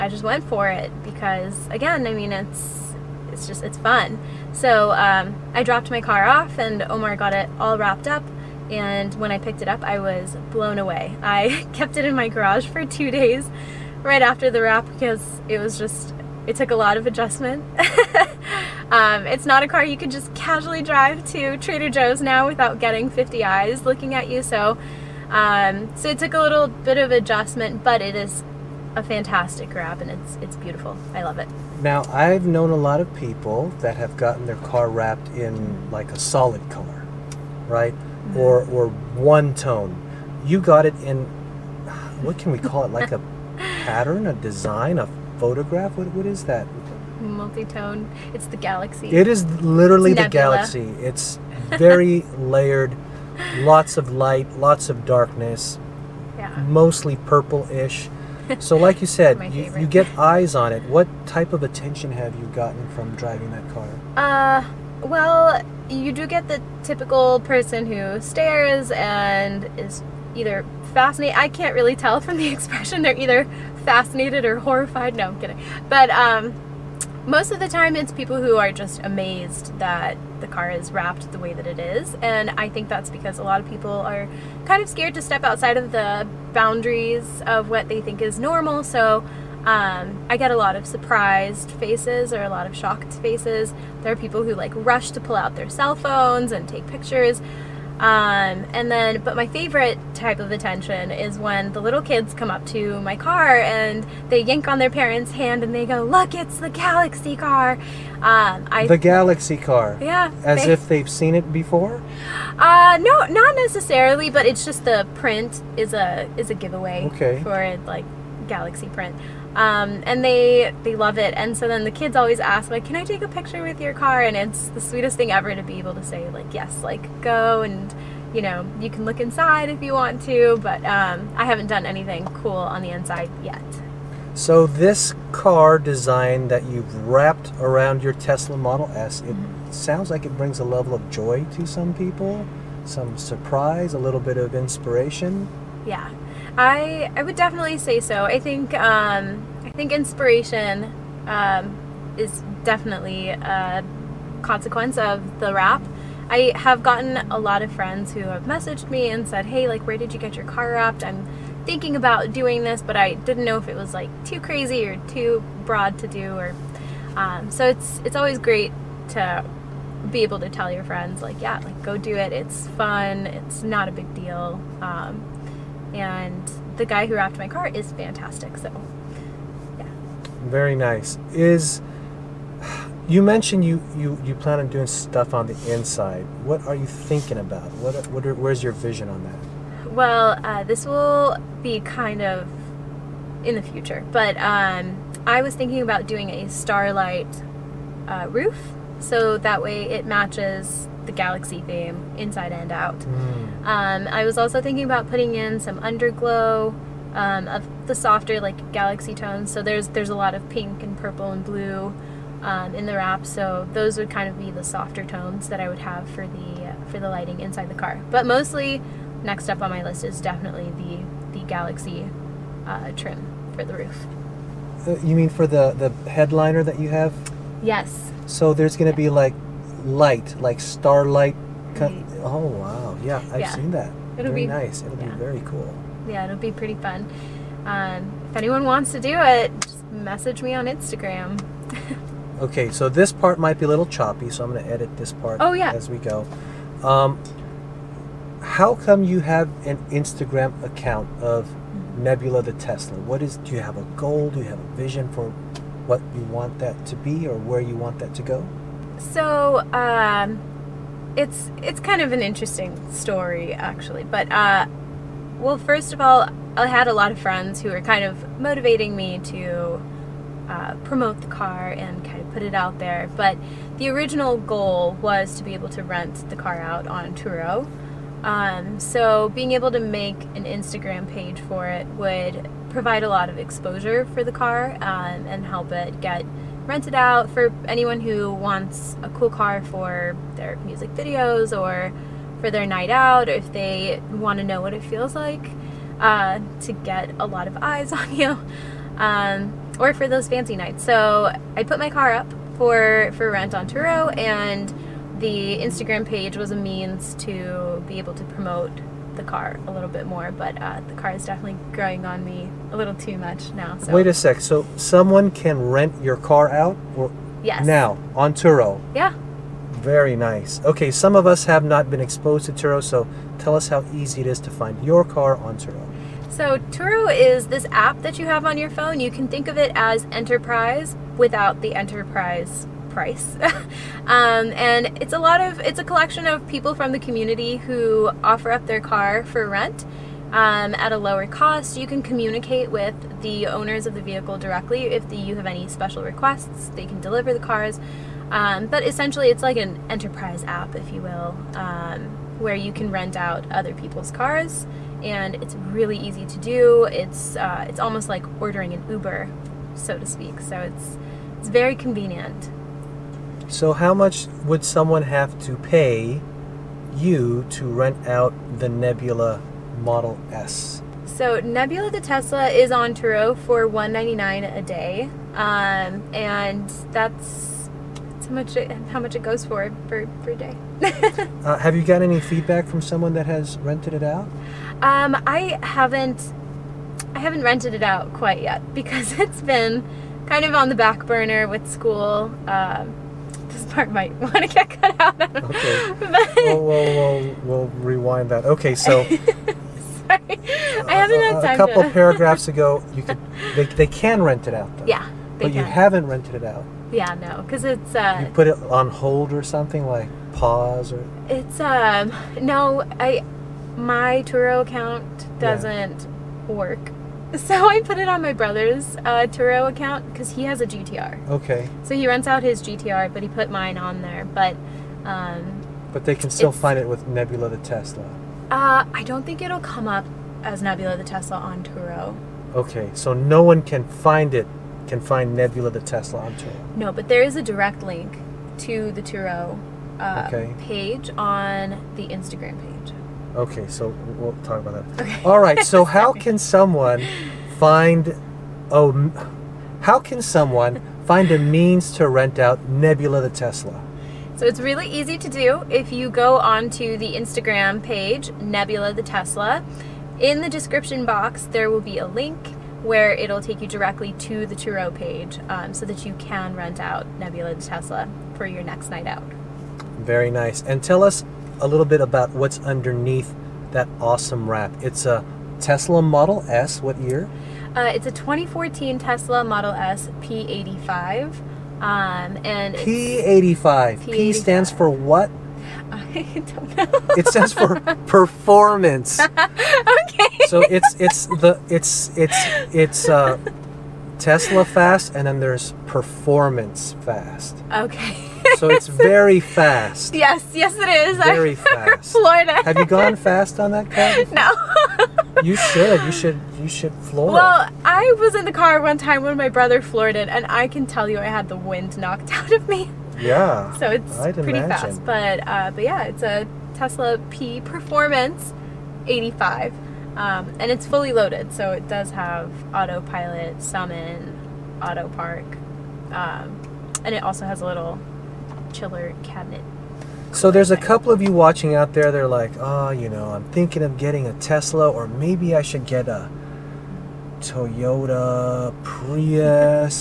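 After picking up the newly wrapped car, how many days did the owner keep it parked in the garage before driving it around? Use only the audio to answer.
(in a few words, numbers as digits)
2.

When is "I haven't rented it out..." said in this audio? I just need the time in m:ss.
6:27.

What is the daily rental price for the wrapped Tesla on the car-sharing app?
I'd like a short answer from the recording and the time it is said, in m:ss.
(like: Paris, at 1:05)
$199, at 6:13.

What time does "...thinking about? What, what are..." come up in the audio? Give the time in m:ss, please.
3:06.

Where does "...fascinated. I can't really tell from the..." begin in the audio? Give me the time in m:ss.
1:10.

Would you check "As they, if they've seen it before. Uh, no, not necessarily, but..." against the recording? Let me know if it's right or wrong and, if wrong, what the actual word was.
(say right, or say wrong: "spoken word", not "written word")
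right.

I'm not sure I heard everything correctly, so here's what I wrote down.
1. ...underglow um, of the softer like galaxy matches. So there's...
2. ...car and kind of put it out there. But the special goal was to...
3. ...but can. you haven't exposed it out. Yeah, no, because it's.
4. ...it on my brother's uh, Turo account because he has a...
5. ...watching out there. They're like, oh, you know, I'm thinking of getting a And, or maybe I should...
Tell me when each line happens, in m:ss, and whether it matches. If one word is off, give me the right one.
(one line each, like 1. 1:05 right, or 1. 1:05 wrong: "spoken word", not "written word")
1. 3:25 wrong: "tones", not "matches"
2. 4:31 wrong: "original", not "special"
3. 6:45 wrong: "rented", not "exposed"
4. 6:57 right
5. 8:51 wrong: "Tesla", not "And".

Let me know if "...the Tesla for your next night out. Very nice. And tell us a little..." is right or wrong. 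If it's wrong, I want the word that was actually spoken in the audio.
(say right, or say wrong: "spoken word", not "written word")
right.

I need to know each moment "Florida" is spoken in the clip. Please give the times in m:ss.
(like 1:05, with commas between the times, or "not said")
8:22.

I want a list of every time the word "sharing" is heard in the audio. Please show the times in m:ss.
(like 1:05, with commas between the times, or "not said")
not said.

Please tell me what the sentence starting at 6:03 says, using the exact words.
So, how much would someone have to pay you to rent out the Nebula Model S?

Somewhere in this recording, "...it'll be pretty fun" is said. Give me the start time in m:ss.
3:56.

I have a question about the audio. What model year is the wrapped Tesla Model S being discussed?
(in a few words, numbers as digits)
2014.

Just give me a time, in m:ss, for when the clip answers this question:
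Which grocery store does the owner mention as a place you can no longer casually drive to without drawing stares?
0:21.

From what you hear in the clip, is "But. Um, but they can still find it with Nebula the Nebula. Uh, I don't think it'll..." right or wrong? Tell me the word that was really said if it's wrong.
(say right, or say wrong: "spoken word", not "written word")
wrong: "Tesla", not "Nebula".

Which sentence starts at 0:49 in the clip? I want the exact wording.
It is literally it's the galaxy.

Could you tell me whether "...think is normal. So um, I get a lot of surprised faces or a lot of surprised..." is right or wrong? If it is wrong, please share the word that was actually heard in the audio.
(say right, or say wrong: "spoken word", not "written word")
wrong: "shocked", not "surprised".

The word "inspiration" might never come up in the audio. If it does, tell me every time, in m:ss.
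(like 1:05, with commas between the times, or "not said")
2:24, 2:29.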